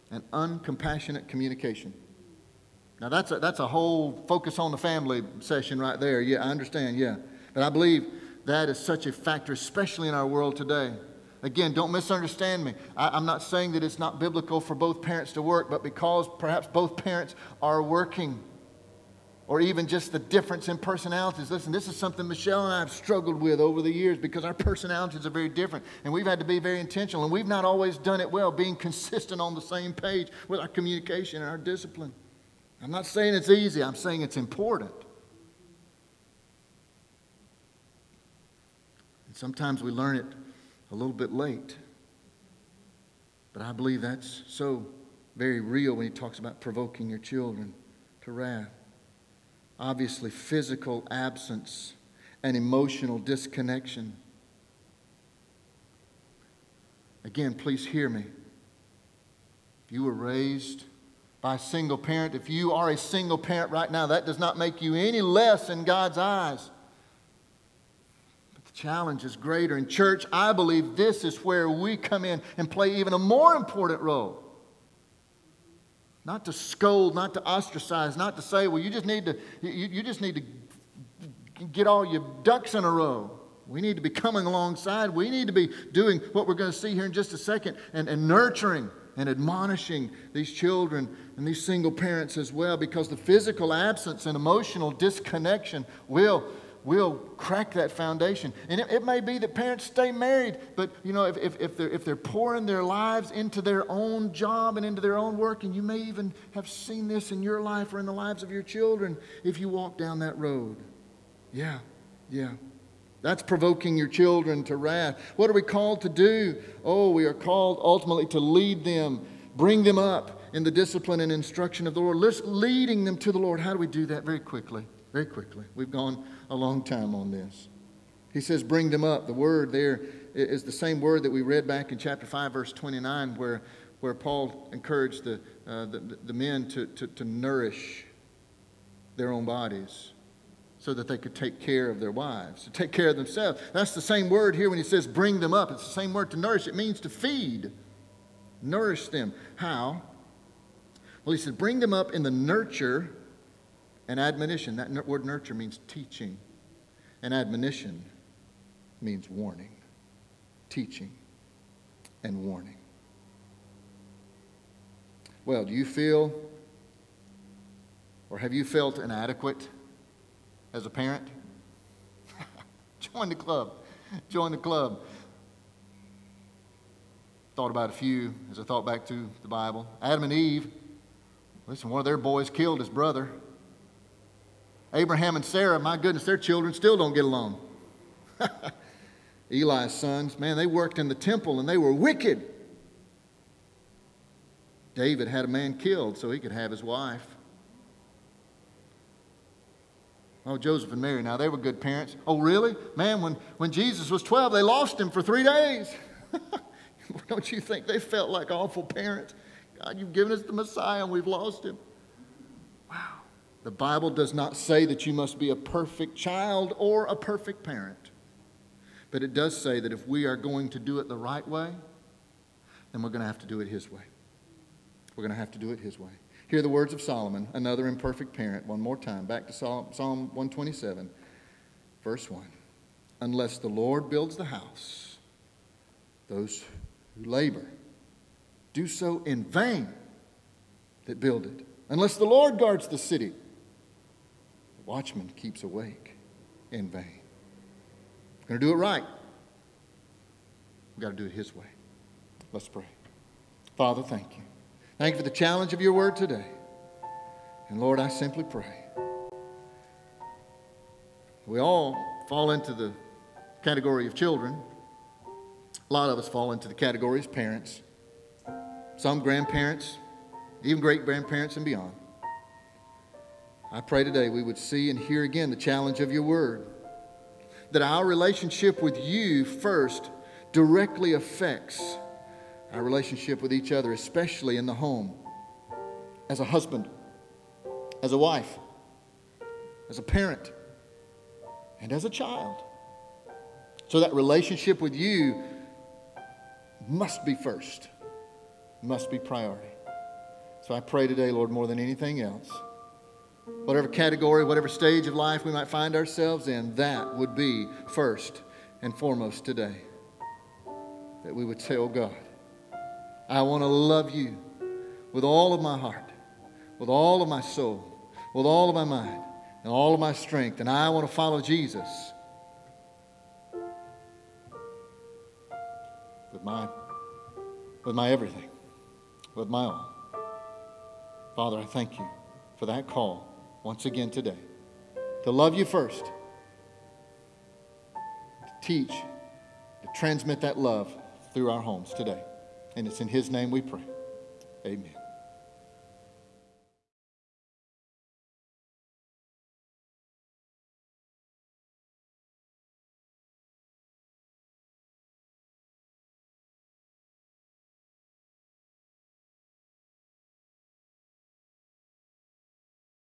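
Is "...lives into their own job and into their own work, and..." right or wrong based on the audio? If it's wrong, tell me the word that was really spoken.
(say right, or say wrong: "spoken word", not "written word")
right.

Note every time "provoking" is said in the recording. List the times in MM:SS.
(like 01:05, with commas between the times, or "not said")
00:46, 01:53.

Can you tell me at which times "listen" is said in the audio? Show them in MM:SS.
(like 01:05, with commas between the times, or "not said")
00:21, 03:01.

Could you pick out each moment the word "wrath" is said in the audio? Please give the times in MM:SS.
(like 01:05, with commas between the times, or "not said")
00:48, 01:54.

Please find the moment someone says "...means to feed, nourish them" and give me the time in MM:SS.
02:26.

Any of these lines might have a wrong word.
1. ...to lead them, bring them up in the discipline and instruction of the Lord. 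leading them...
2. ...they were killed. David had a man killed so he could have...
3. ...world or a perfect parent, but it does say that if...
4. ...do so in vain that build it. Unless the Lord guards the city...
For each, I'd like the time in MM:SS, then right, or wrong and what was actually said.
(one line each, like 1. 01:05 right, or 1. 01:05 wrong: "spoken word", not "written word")
1. 01:58 right
2. 03:11 wrong: "wicked", not "killed"
3. 03:36 wrong: "child", not "world"
4. 03:58 right.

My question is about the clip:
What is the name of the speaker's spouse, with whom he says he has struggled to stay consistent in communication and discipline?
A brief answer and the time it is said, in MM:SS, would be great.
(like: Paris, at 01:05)
Michelle, at 00:22.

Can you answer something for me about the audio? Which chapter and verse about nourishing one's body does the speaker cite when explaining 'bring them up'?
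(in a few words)
Chapter 5, verse 29.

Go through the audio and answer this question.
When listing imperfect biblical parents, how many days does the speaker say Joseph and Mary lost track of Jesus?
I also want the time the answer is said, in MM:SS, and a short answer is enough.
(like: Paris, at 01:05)
3, at 03:25.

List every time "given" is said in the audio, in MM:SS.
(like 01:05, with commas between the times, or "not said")
03:30.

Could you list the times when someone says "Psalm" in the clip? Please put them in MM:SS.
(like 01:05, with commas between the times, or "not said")
03:49.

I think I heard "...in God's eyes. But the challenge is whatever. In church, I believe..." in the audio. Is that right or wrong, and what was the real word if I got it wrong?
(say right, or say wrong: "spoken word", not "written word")
wrong: "greater", not "whatever".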